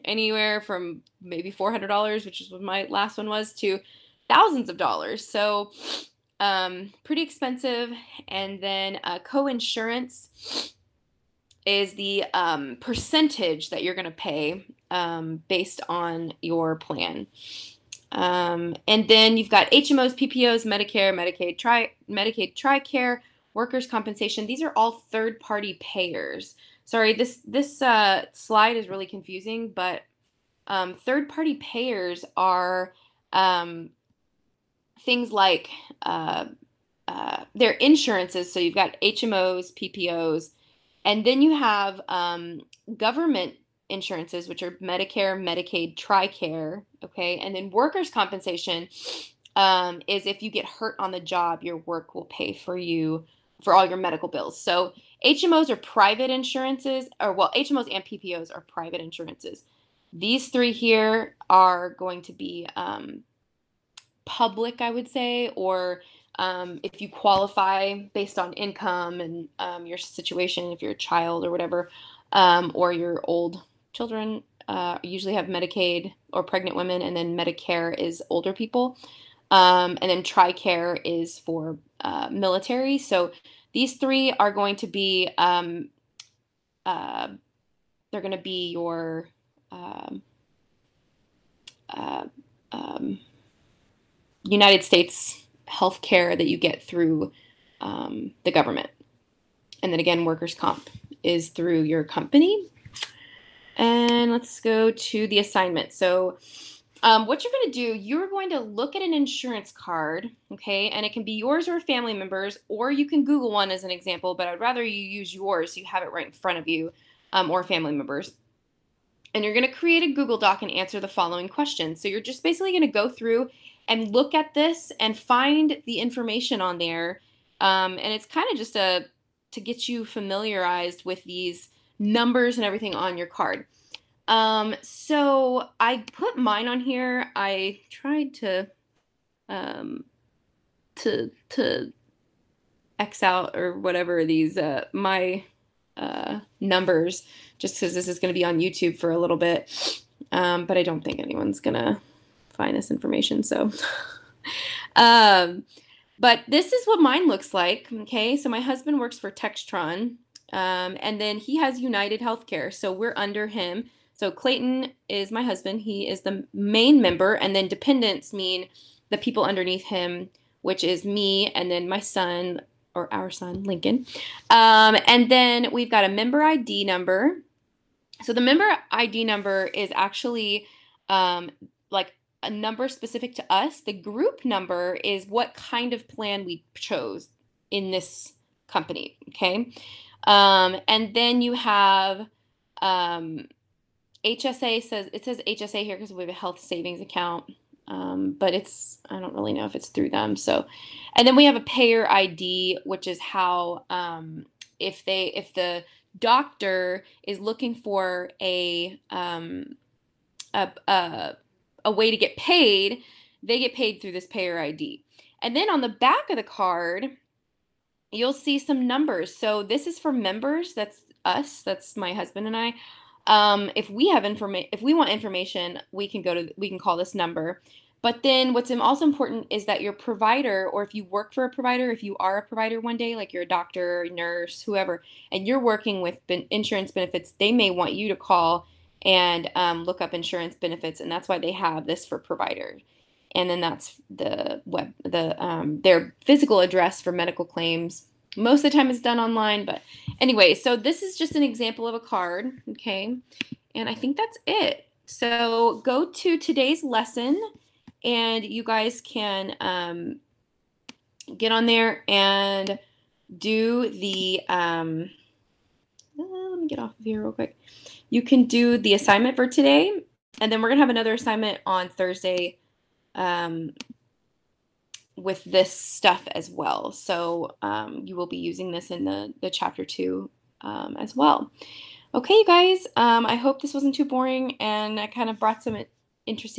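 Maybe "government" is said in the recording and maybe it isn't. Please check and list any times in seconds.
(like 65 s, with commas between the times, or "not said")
42 s, 98 s.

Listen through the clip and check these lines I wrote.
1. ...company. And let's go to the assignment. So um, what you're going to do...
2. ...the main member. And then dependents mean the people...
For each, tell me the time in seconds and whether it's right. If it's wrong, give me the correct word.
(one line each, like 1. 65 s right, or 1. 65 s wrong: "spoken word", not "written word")
1. 102 s right
2. 166 s right.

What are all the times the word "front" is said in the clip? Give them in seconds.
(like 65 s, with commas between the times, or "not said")
116 s.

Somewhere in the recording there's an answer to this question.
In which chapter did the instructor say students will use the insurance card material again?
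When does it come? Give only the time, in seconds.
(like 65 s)
279 s.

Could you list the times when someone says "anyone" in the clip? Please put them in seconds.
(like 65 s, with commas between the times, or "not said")
151 s.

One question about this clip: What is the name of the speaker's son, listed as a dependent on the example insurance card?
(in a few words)
Lincoln.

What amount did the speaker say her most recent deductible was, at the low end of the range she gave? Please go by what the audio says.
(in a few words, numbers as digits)
$400.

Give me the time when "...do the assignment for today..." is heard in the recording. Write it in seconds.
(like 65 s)
268 s.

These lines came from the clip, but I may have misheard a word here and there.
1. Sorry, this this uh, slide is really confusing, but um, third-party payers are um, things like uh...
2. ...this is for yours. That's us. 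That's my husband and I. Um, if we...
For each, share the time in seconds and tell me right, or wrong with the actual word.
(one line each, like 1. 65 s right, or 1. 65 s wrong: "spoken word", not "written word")
1. 26 s right
2. 219 s wrong: "members", not "yours".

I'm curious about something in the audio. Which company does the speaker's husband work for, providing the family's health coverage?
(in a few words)
Textron.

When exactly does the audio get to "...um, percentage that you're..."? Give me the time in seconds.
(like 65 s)
12 s.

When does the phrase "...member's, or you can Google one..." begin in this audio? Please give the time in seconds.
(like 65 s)
112 s.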